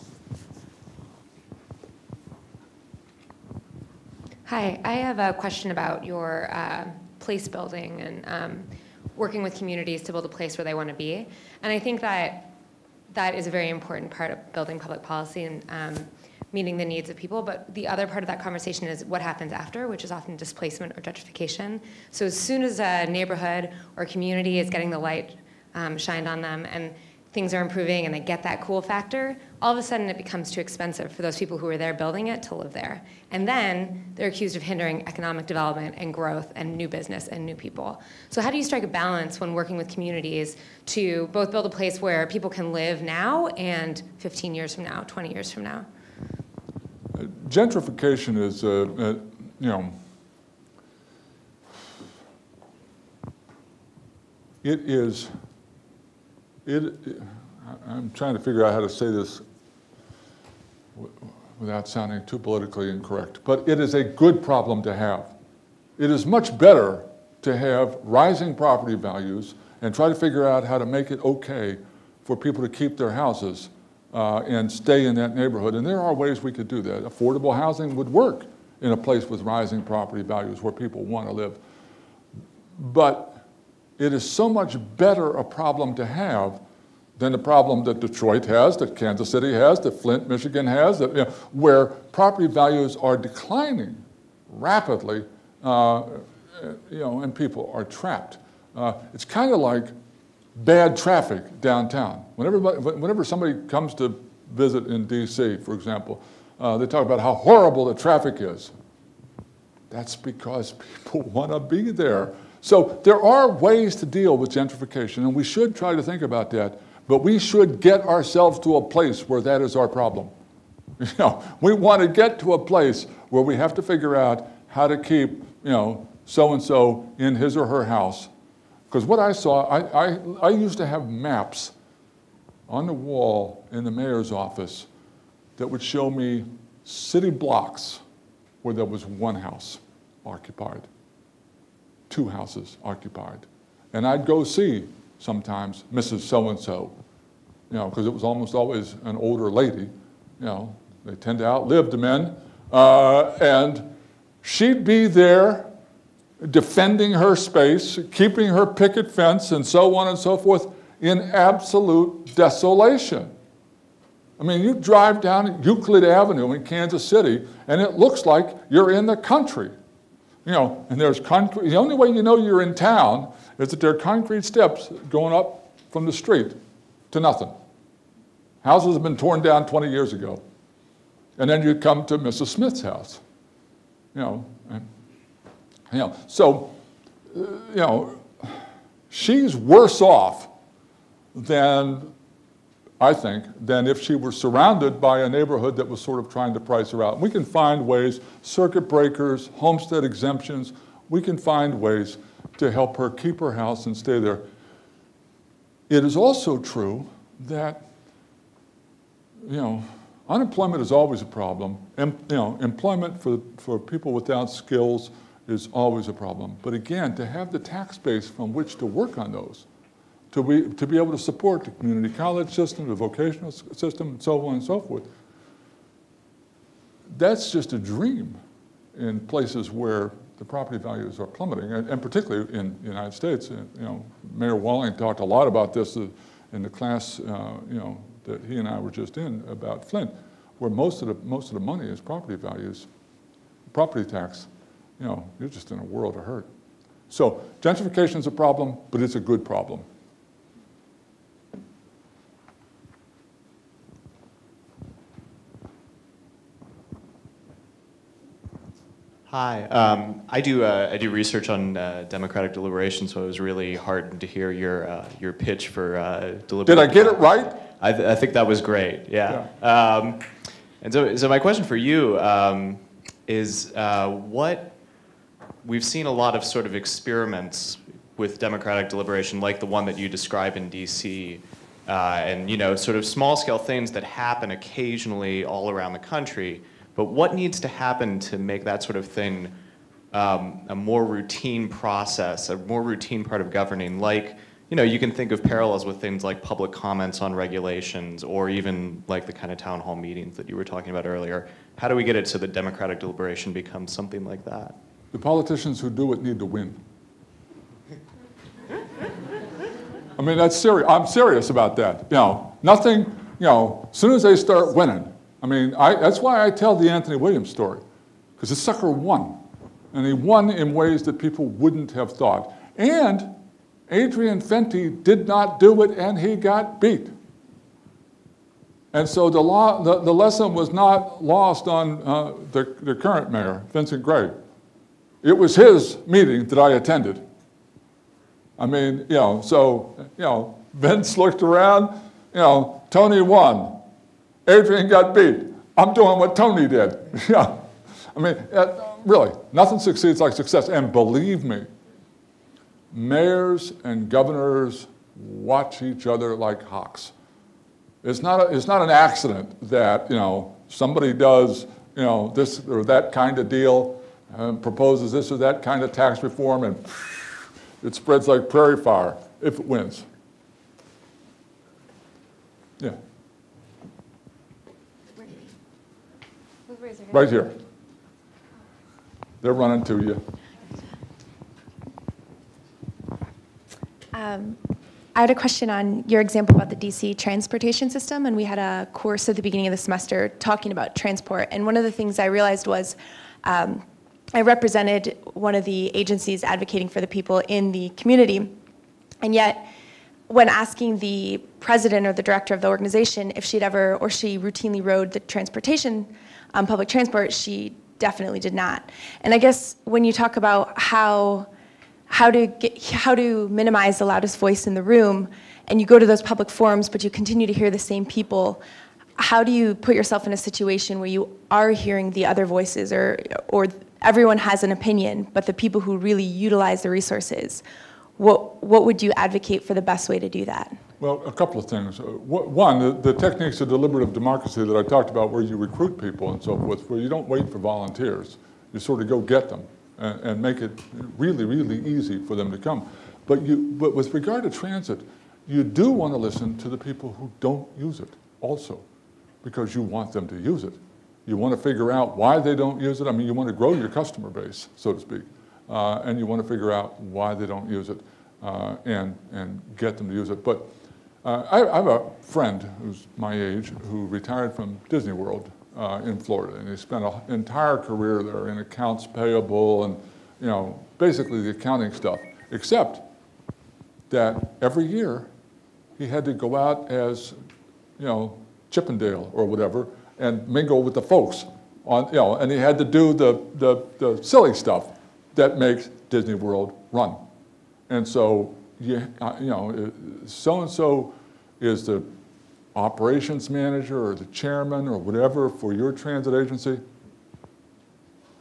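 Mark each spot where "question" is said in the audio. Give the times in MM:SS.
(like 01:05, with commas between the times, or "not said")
00:05, 04:31, 06:25.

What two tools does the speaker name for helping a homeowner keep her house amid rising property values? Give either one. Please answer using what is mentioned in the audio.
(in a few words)
Circuit breakers.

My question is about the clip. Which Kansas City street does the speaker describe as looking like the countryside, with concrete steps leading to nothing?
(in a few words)
Euclid Avenue.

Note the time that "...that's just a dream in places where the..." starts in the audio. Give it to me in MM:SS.
03:47.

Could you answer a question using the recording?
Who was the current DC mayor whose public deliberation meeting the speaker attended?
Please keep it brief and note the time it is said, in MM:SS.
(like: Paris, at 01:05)
Vincent Gray, at 05:33.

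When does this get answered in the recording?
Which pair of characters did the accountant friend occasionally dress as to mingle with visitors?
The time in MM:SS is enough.
07:58.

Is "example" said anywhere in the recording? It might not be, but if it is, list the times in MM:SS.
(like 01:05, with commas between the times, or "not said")
01:45, 06:26.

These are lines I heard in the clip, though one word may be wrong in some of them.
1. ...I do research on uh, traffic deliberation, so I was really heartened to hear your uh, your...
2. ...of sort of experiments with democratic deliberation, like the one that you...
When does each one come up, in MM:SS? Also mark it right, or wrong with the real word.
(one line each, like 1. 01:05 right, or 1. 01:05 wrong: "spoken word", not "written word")
1. 04:20 wrong: "democratic", not "traffic"
2. 04:36 right.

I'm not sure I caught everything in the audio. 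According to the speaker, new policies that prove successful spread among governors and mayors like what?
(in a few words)
Prairie fire.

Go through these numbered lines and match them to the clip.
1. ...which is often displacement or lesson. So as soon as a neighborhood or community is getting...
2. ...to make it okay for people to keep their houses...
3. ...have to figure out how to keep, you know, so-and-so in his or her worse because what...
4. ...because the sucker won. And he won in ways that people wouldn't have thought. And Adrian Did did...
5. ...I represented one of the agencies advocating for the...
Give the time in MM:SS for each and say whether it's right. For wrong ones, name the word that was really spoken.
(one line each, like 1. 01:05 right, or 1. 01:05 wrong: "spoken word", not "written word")
1. 00:19 wrong: "gentrification", not "lesson"
2. 01:10 right
3. 02:03 wrong: "house", not "worse"
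4. 05:18 wrong: "Fenty", not "Did"
5. 06:34 right.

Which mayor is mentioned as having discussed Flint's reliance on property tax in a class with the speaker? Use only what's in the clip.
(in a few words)
Mayor Walling.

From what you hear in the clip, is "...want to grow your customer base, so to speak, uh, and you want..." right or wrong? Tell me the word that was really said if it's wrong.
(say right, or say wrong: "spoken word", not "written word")
right.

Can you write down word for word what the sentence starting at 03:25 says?
It is also true that, you know, unemployment is always a problem.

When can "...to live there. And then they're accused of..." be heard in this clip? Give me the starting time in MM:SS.
00:32.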